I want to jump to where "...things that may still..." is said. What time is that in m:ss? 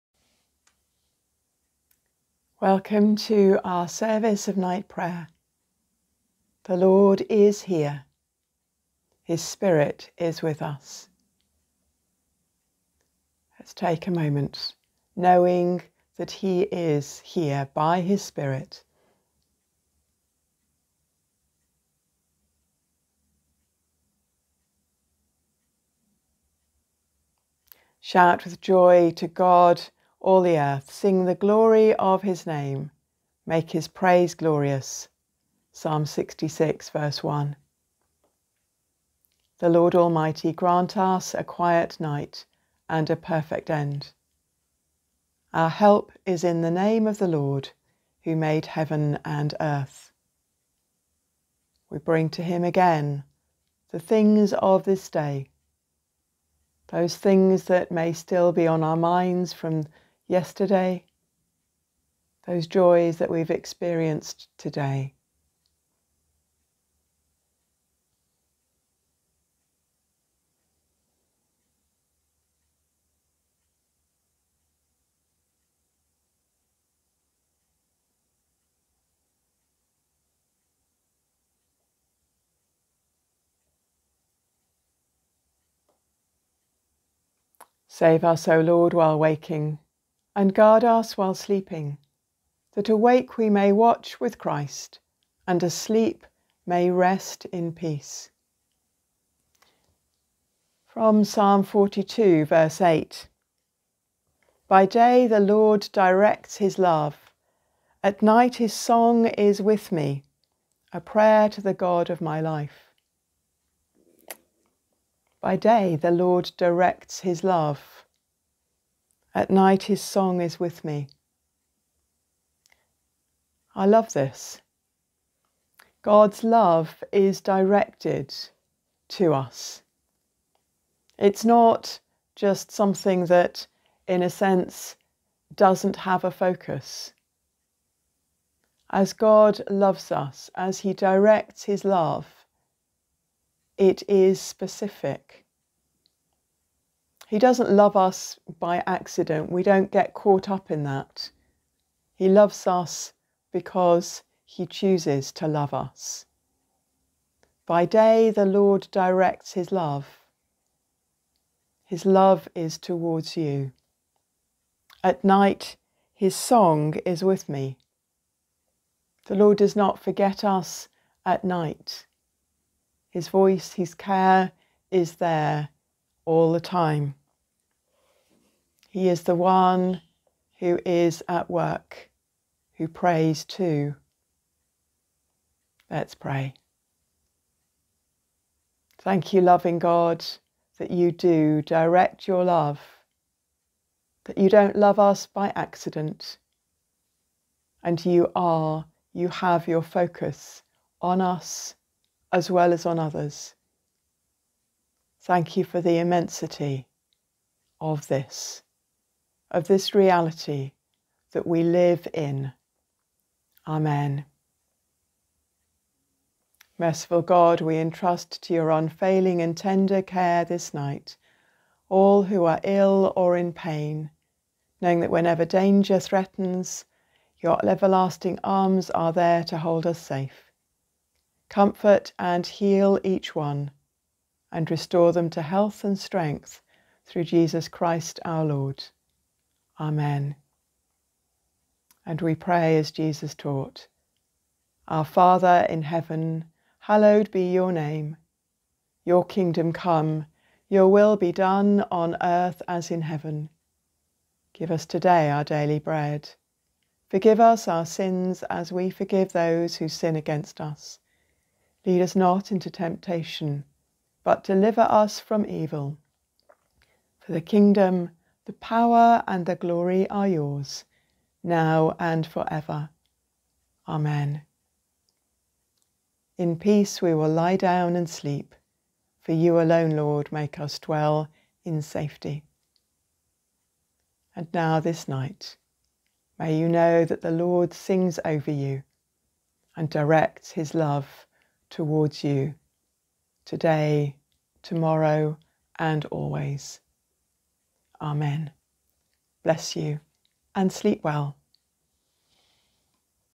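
0:57.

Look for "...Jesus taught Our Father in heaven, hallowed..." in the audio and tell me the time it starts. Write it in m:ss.
4:02.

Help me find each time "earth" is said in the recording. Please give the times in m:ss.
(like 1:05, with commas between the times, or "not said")
0:30, 0:49, 4:12.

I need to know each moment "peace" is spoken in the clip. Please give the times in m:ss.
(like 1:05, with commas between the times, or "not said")
1:37, 4:36.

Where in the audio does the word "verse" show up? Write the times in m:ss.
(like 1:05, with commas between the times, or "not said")
0:36, 1:42.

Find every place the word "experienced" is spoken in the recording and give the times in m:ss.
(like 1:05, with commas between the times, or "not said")
1:03.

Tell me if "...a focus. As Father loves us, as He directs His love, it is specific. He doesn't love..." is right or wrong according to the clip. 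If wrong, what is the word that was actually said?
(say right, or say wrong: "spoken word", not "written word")
wrong: "God", not "Father".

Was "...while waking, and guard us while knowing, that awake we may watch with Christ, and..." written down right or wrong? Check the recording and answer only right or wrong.
wrong.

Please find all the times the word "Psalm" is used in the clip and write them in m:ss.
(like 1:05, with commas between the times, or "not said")
0:35, 1:41.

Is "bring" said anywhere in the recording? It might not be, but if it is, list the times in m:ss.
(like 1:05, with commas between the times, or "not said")
0:51.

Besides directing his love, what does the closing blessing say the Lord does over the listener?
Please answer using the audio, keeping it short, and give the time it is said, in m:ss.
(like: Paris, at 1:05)
Sings, at 4:47.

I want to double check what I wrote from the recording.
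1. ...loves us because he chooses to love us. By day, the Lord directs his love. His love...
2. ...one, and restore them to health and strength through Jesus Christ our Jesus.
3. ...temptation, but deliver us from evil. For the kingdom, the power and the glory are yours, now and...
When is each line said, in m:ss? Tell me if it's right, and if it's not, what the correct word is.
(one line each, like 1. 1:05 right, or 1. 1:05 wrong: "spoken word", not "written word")
1. 2:32 right
2. 3:53 wrong: "Lord", not "Jesus"
3. 4:22 right.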